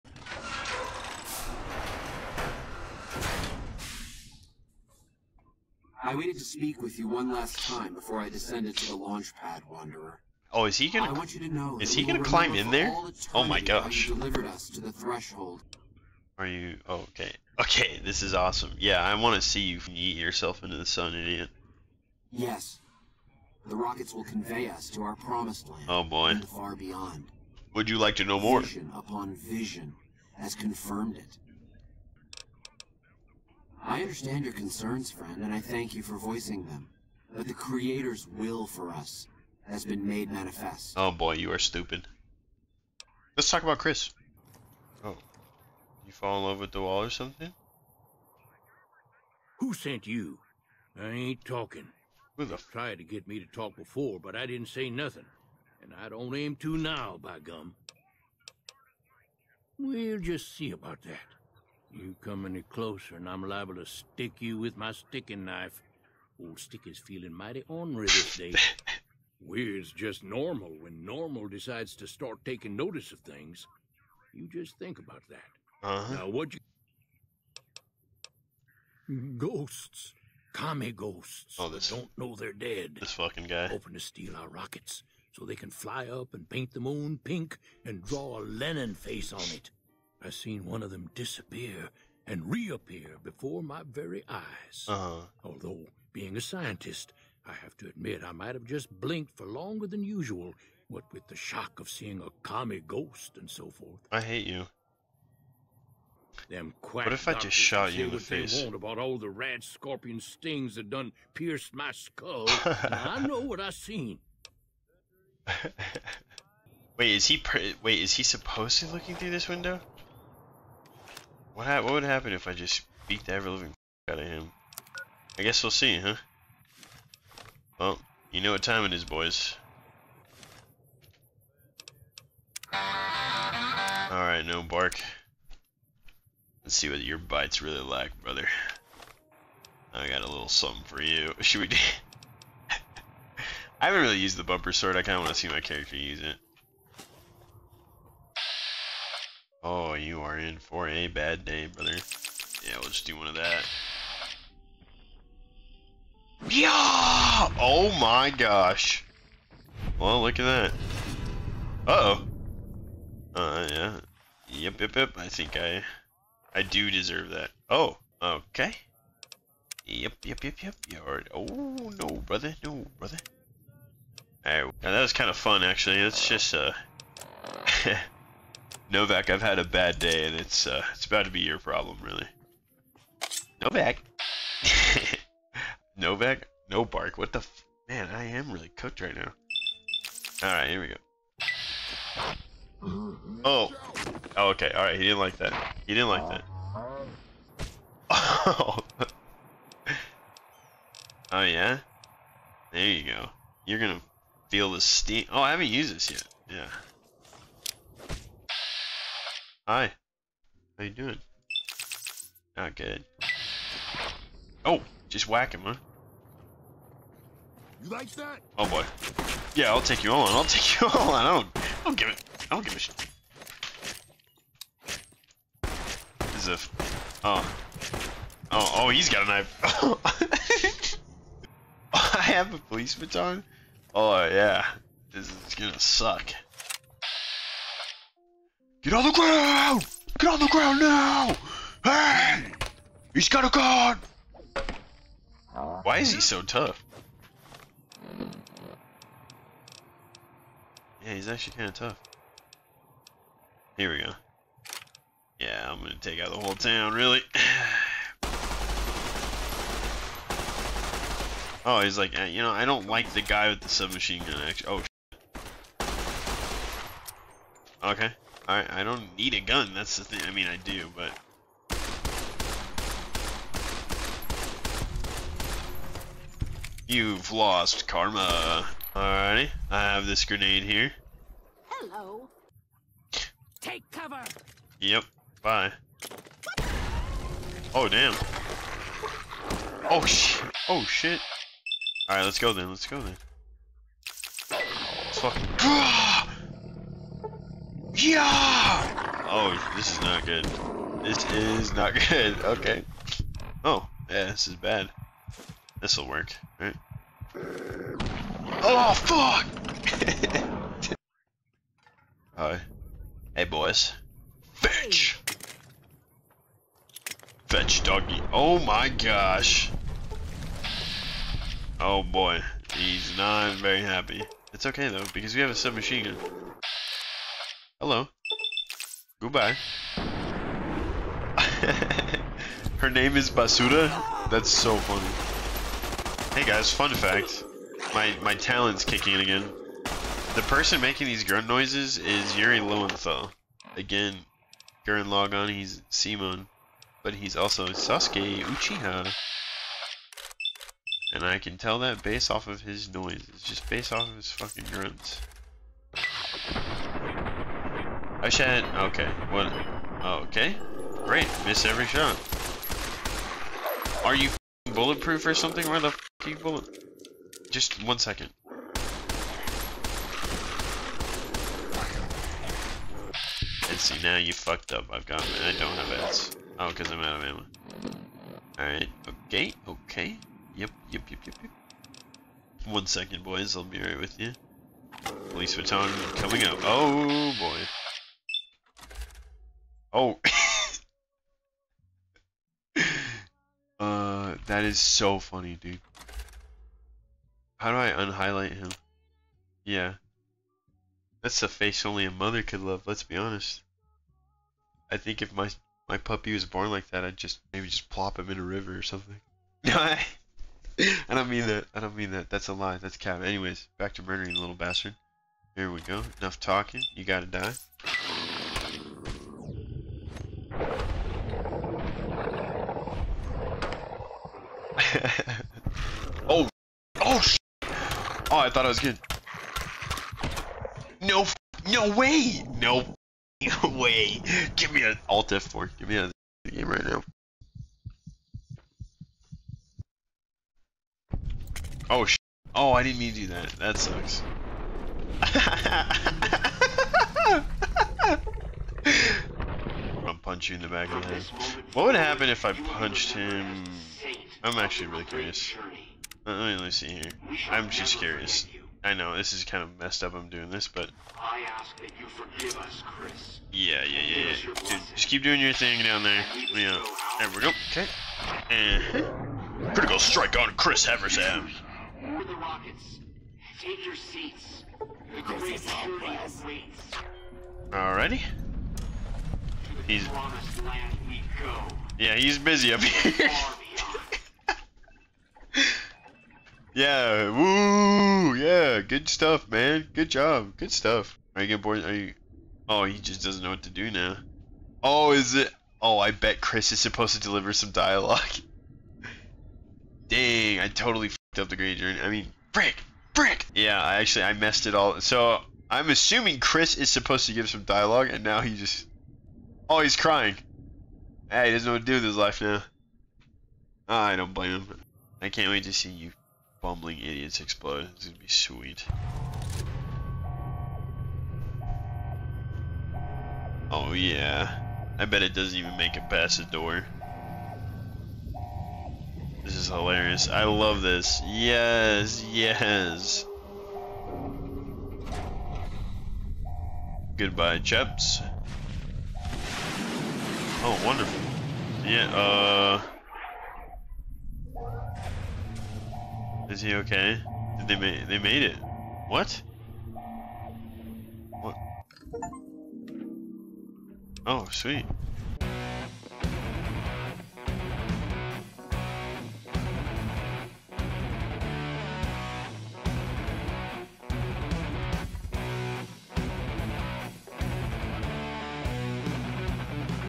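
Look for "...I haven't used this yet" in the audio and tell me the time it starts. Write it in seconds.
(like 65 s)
205 s.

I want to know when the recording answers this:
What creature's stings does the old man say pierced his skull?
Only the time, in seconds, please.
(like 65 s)
109 s.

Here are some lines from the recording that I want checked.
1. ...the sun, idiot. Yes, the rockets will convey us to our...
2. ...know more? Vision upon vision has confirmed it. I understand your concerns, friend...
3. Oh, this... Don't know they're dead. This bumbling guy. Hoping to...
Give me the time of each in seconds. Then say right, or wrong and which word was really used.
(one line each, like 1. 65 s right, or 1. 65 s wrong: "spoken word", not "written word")
1. 20 s right
2. 28 s right
3. 81 s wrong: "fucking", not "bumbling".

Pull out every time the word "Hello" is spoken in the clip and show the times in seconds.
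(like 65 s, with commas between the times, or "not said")
281 s, 327 s.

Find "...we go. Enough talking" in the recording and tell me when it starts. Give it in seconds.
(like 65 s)
415 s.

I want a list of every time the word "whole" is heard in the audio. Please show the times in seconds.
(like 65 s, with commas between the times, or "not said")
256 s.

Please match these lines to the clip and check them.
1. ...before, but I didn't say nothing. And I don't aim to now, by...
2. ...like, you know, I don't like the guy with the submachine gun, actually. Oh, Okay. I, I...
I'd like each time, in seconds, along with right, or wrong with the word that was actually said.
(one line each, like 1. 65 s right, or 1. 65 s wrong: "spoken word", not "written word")
1. 53 s right
2. 261 s right.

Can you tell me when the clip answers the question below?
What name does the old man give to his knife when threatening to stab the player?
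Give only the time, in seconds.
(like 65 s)
66 s.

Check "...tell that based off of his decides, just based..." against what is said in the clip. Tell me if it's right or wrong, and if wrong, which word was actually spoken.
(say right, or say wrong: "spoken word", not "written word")
wrong: "noises", not "decides".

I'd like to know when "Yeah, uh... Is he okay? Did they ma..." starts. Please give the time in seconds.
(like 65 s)
541 s.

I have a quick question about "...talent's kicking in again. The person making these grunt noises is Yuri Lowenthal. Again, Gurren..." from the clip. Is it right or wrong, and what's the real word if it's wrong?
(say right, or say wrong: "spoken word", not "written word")
right.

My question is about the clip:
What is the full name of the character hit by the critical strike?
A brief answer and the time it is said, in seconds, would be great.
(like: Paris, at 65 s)
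Chris Haversam, at 470 s.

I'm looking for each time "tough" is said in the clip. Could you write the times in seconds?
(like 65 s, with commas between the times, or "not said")
246 s, 251 s.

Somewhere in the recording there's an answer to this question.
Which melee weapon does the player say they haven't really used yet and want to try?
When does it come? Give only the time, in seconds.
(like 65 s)
144 s.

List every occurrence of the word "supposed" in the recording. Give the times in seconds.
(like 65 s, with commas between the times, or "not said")
118 s, 496 s, 506 s.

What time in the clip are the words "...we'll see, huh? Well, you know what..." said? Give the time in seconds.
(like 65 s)
125 s.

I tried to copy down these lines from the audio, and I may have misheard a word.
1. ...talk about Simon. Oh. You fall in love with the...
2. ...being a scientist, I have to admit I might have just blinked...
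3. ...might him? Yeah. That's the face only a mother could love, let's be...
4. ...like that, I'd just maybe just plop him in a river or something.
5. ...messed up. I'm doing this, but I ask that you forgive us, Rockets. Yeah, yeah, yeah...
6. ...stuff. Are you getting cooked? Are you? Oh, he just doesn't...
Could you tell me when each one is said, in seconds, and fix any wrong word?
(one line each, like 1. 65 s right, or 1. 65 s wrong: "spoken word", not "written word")
1. 43 s wrong: "Chris", not "Simon"
2. 96 s right
3. 397 s wrong: "unhighlight", not "might"
4. 406 s right
5. 459 s wrong: "Chris", not "Rockets"
6. 490 s wrong: "bored", not "cooked".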